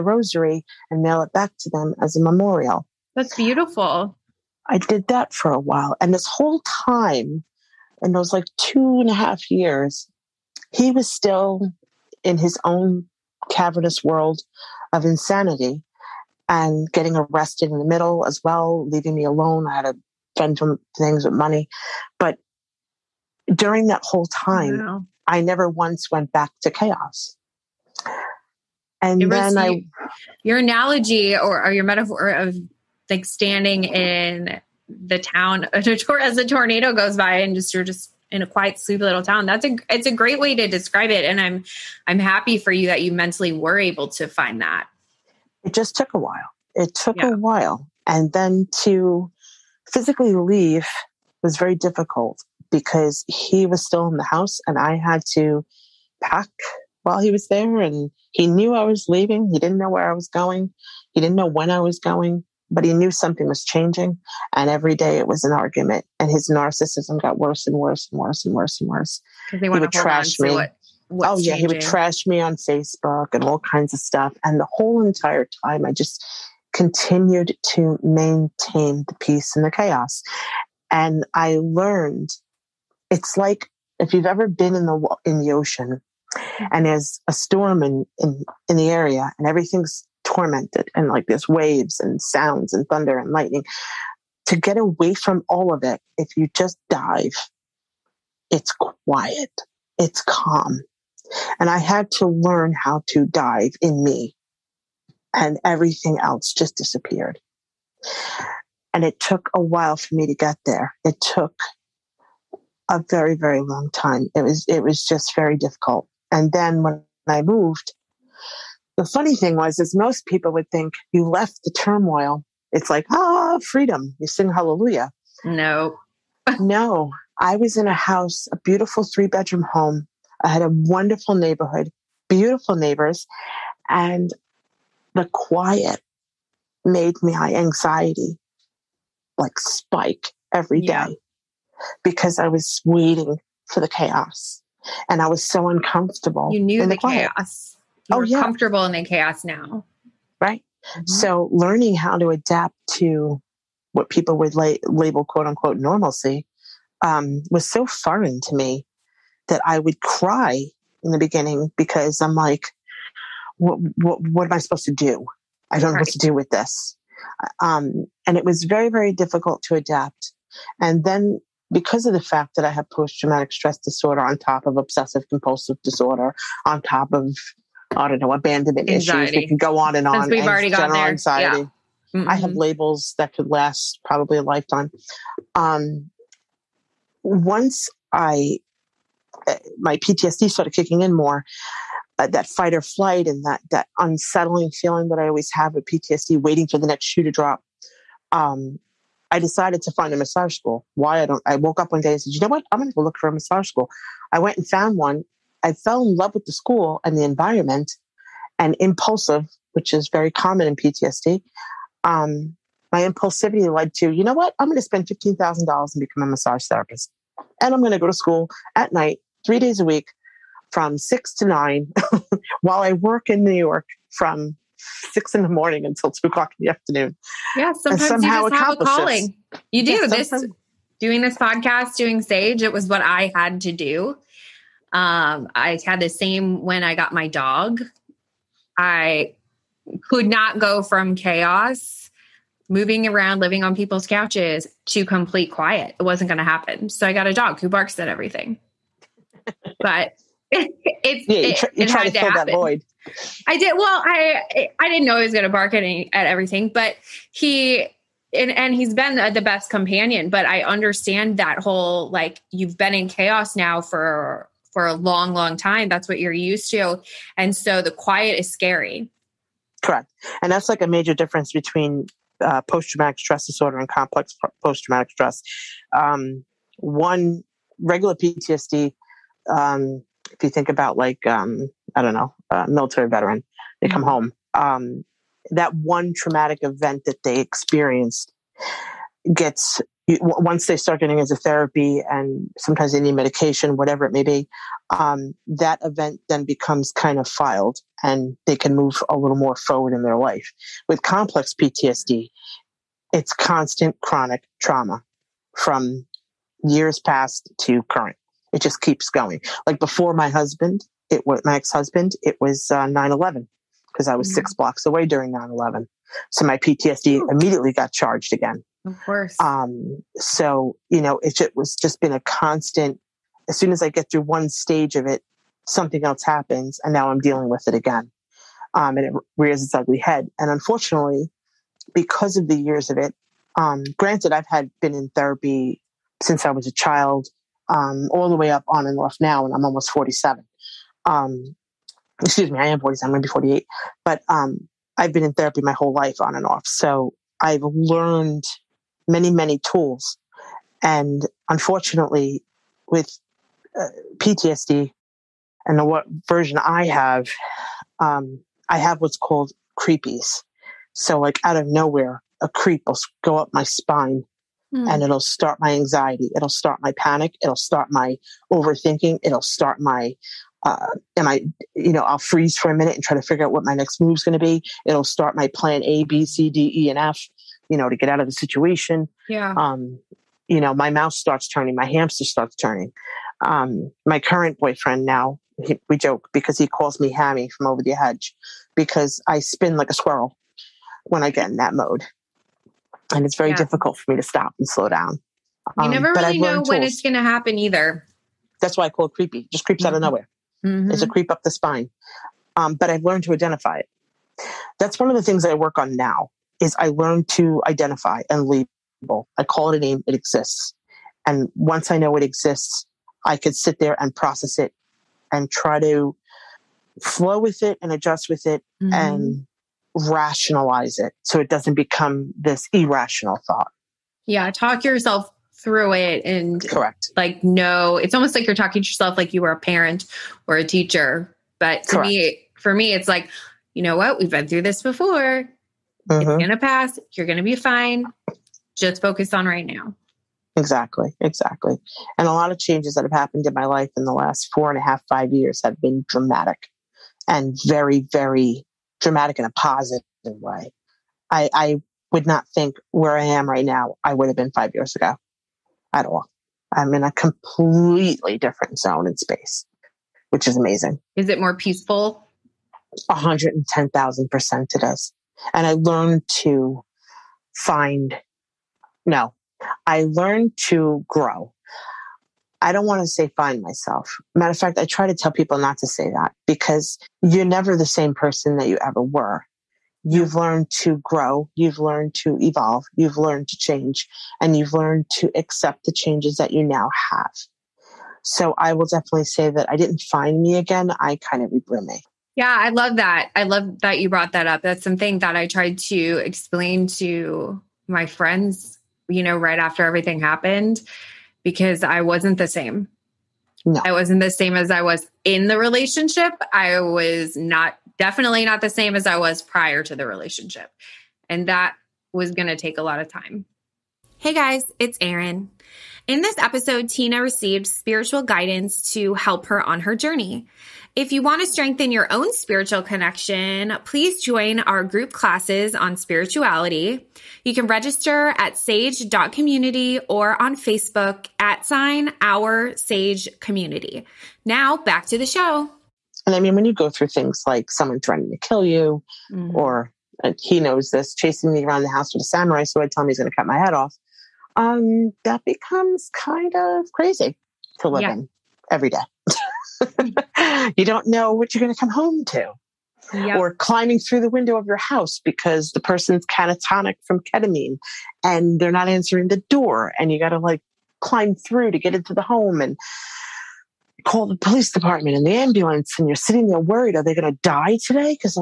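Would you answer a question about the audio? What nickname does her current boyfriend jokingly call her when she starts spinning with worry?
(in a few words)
Hammy.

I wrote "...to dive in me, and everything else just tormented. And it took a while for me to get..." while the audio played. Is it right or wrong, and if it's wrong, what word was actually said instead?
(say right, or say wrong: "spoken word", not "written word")
wrong: "disappeared", not "tormented".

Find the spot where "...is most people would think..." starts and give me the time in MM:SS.
01:59.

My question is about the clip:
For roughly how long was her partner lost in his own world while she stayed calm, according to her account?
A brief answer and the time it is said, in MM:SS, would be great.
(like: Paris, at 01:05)
2 and a half years, at 00:08.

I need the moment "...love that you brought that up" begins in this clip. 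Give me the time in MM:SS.
08:13.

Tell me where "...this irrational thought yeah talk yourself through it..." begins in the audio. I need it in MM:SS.
07:02.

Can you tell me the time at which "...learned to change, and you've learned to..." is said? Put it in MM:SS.
08:03.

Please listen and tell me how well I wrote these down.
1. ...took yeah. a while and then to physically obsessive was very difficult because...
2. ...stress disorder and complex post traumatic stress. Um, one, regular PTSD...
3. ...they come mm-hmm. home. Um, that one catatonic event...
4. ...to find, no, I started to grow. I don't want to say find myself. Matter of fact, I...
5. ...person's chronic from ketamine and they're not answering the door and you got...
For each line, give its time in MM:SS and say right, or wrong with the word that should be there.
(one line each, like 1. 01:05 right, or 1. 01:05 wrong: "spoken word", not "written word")
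1. 00:46 wrong: "leave", not "obsessive"
2. 04:33 right
3. 04:43 wrong: "traumatic", not "catatonic"
4. 07:46 wrong: "learned", not "started"
5. 09:15 wrong: "catatonic", not "chronic".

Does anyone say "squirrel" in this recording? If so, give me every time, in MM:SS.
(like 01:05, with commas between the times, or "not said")
06:29.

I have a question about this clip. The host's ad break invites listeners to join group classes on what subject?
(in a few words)
spirituality.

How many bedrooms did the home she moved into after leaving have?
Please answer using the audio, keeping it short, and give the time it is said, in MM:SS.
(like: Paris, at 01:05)
3, at 02:09.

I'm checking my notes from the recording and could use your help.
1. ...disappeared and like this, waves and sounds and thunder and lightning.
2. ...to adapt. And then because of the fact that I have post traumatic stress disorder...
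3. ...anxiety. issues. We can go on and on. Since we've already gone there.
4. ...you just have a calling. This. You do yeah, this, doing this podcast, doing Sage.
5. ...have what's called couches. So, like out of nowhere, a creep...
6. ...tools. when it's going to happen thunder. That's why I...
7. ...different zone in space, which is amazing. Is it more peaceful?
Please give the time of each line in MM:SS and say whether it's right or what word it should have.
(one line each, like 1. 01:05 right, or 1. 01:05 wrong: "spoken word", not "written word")
1. 01:30 wrong: "tormented", not "disappeared"
2. 02:49 right
3. 02:58 right
4. 03:48 right
5. 05:58 wrong: "creepies", not "couches"
6. 06:36 wrong: "either", not "thunder"
7. 07:38 right.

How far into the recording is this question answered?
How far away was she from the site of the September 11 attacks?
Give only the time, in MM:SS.
05:14.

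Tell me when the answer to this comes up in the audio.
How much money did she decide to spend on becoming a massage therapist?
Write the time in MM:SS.
03:35.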